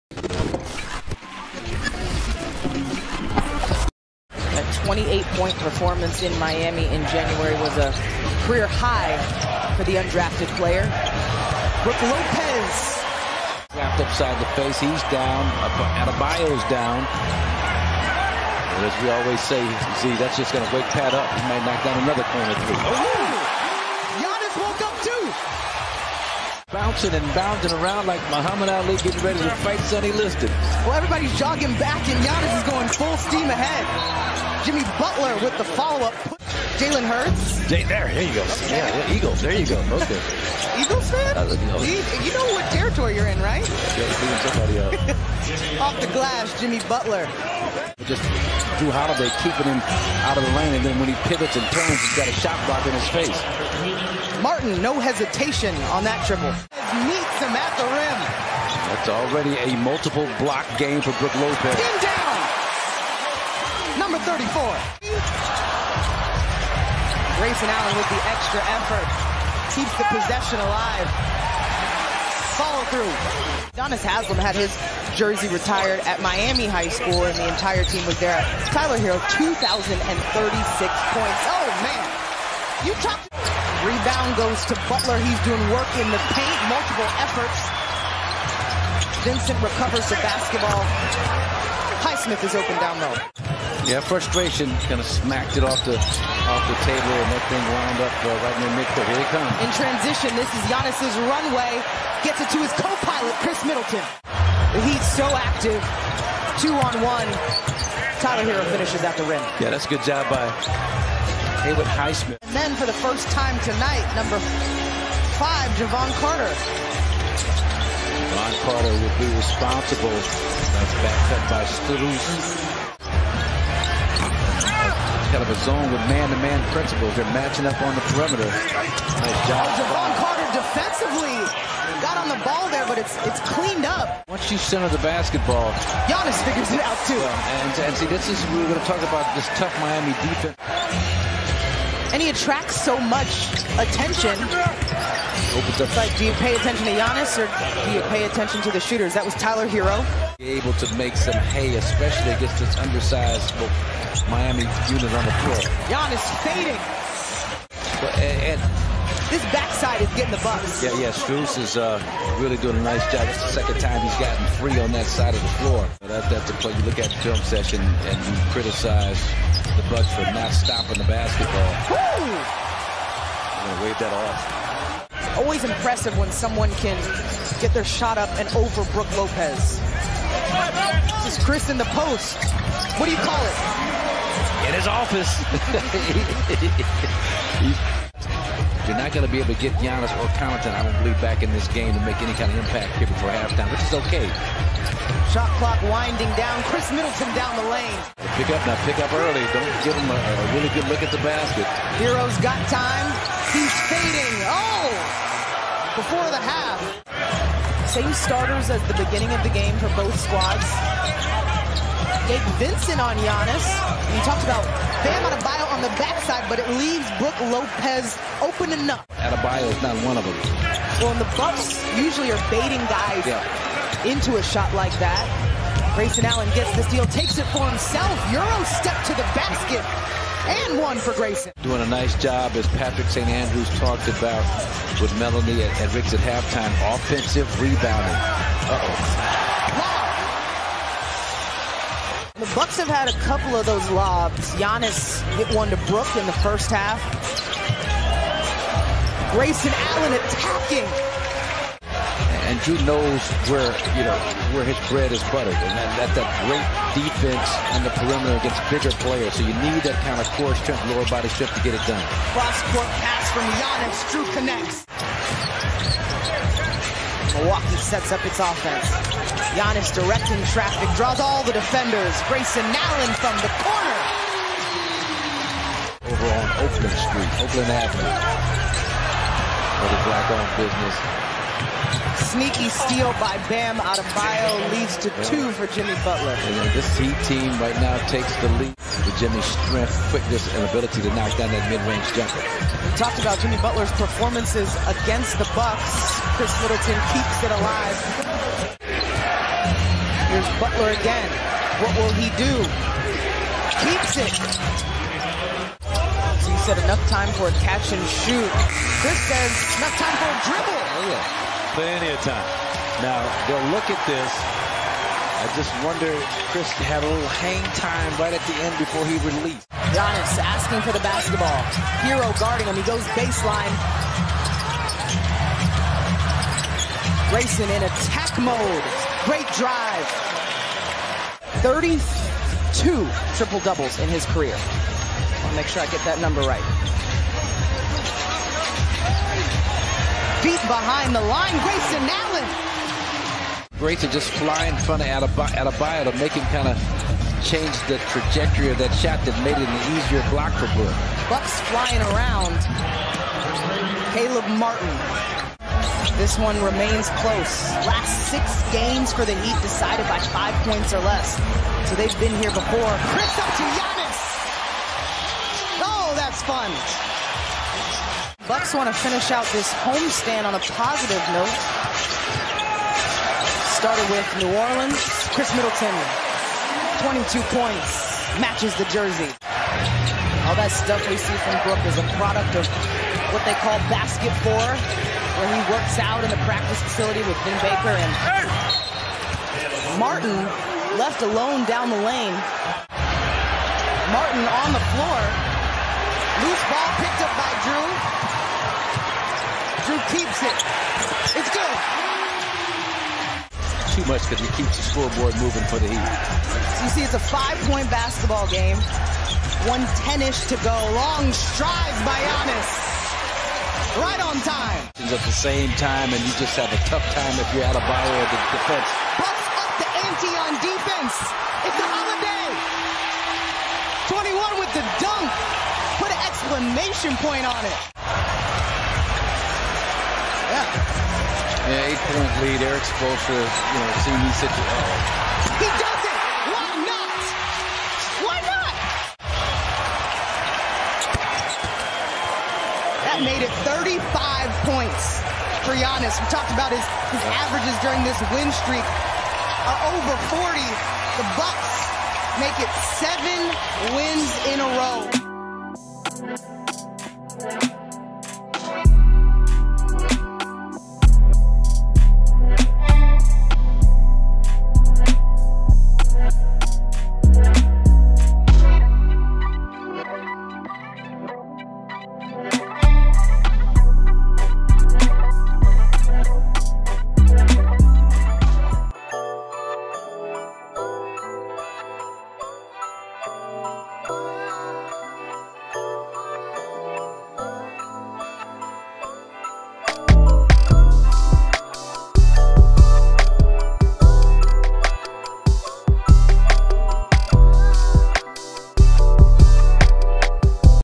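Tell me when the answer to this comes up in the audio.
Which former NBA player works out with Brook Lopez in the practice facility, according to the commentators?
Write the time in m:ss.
6:27.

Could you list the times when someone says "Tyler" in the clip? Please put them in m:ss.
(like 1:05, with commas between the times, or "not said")
1:18, 1:48, 2:29.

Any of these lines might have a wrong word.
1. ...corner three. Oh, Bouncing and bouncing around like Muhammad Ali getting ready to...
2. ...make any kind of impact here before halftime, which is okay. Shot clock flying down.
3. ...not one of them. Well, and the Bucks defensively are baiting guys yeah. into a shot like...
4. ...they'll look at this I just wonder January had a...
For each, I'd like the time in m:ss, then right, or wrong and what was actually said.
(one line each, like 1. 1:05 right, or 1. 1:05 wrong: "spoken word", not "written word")
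1. 0:22 right
2. 3:12 wrong: "winding", not "flying"
3. 3:39 wrong: "usually", not "defensively"
4. 5:13 wrong: "Khris", not "January".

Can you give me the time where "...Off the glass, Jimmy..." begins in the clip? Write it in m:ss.
0:45.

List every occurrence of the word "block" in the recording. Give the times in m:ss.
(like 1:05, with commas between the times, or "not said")
0:52, 1:00, 5:50.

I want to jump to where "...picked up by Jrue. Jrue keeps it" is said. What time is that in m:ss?
6:37.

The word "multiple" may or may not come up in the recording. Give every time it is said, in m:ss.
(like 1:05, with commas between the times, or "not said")
0:59, 1:26.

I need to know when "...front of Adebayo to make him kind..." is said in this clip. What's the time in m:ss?
5:44.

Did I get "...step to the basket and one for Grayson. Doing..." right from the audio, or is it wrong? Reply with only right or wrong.
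right.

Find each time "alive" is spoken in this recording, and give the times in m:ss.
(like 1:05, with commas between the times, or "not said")
1:10, 4:57.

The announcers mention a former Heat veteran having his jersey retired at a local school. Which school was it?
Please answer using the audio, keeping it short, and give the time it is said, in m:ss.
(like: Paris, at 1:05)
Miami High School, at 1:16.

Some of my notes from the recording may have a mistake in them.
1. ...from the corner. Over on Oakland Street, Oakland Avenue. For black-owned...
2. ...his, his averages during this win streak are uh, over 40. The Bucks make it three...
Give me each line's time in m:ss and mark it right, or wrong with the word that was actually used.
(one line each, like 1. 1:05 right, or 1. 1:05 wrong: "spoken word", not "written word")
1. 4:33 right
2. 7:26 wrong: "seven", not "three".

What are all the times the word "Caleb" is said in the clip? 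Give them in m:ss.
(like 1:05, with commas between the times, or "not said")
5:54.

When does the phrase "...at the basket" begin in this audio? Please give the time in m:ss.
3:21.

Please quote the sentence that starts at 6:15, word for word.
Khris Middleton, 22 points, matches the jersey.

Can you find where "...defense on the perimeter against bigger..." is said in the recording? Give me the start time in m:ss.
4:16.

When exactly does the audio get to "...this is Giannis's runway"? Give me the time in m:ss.
1:40.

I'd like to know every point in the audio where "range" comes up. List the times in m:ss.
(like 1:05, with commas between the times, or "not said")
4:51.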